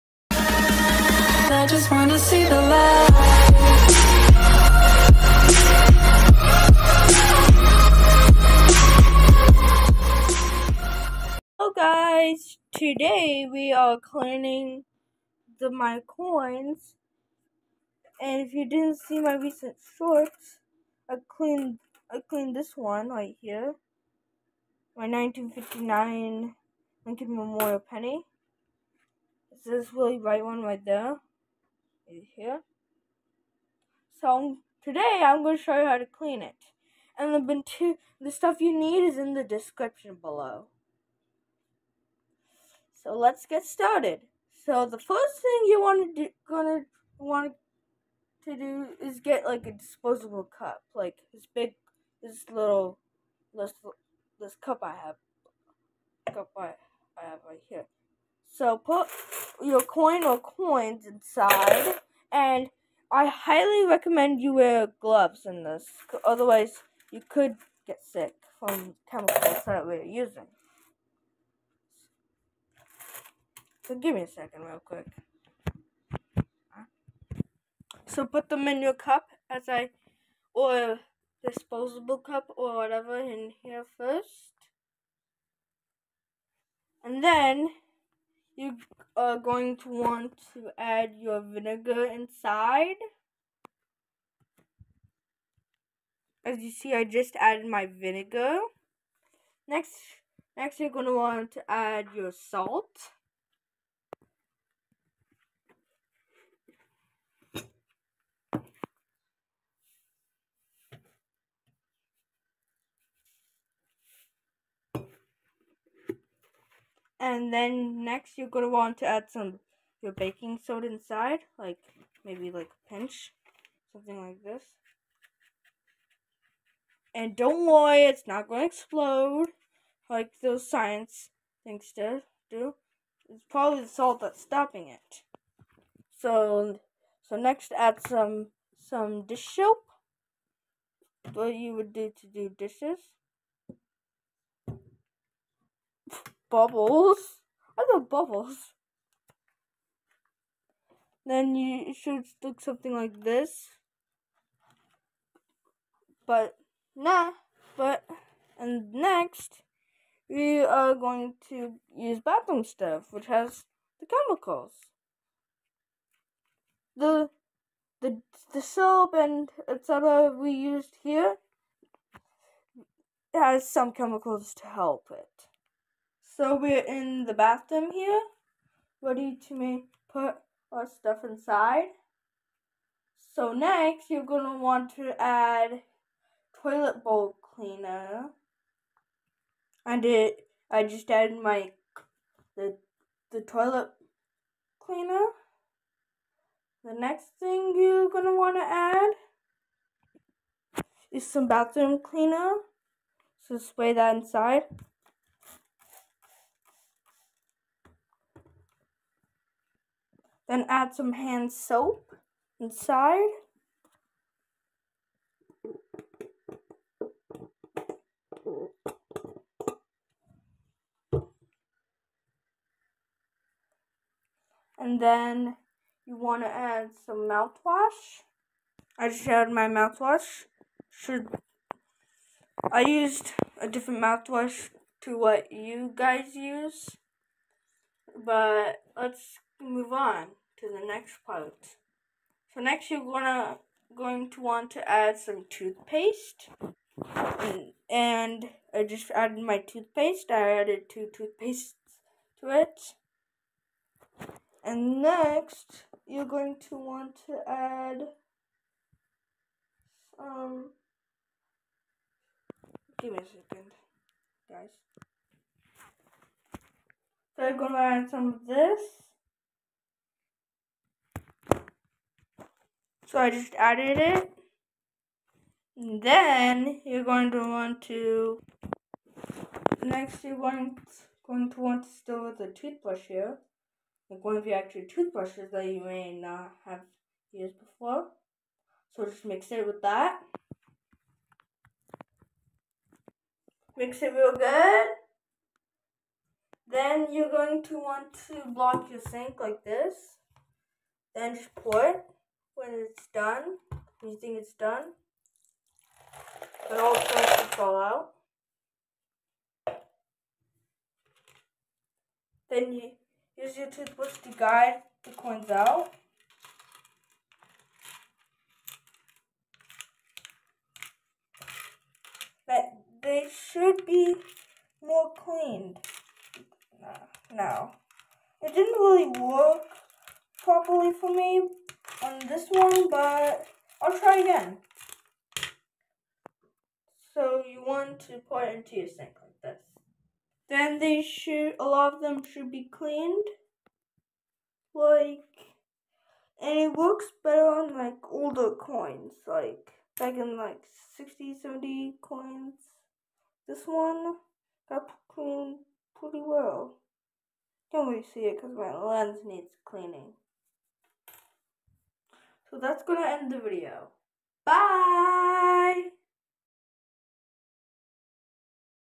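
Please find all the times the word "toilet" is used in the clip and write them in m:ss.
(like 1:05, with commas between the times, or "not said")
3:06, 3:13.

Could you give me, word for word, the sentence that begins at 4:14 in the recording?
And next, you're going to want to add some.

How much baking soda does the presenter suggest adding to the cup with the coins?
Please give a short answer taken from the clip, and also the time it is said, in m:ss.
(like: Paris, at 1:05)
a pinch, at 2:02.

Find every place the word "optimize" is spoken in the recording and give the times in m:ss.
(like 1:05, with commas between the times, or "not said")
not said.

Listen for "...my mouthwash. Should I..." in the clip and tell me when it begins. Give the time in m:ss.
3:49.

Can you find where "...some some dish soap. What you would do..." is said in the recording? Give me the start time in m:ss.
2:18.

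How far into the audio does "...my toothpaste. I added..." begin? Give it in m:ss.
4:09.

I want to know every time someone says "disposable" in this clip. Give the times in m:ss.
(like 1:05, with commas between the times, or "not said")
0:49, 1:21.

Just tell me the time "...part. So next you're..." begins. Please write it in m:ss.
4:01.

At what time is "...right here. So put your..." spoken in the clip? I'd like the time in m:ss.
0:57.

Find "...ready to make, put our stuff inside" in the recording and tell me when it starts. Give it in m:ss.
2:58.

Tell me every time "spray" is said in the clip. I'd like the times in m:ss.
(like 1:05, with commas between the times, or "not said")
3:23.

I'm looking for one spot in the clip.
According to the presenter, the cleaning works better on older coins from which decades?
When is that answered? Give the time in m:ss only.
5:50.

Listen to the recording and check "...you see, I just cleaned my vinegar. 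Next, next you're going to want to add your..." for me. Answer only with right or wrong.
wrong.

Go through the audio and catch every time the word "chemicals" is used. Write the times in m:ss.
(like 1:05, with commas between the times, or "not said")
1:09, 2:44, 2:53.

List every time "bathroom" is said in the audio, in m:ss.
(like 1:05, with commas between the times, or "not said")
2:42, 2:57, 3:21.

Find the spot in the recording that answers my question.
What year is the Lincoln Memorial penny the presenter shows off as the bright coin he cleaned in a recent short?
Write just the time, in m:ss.
0:25.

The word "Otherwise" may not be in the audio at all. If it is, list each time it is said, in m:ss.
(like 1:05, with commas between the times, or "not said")
1:06.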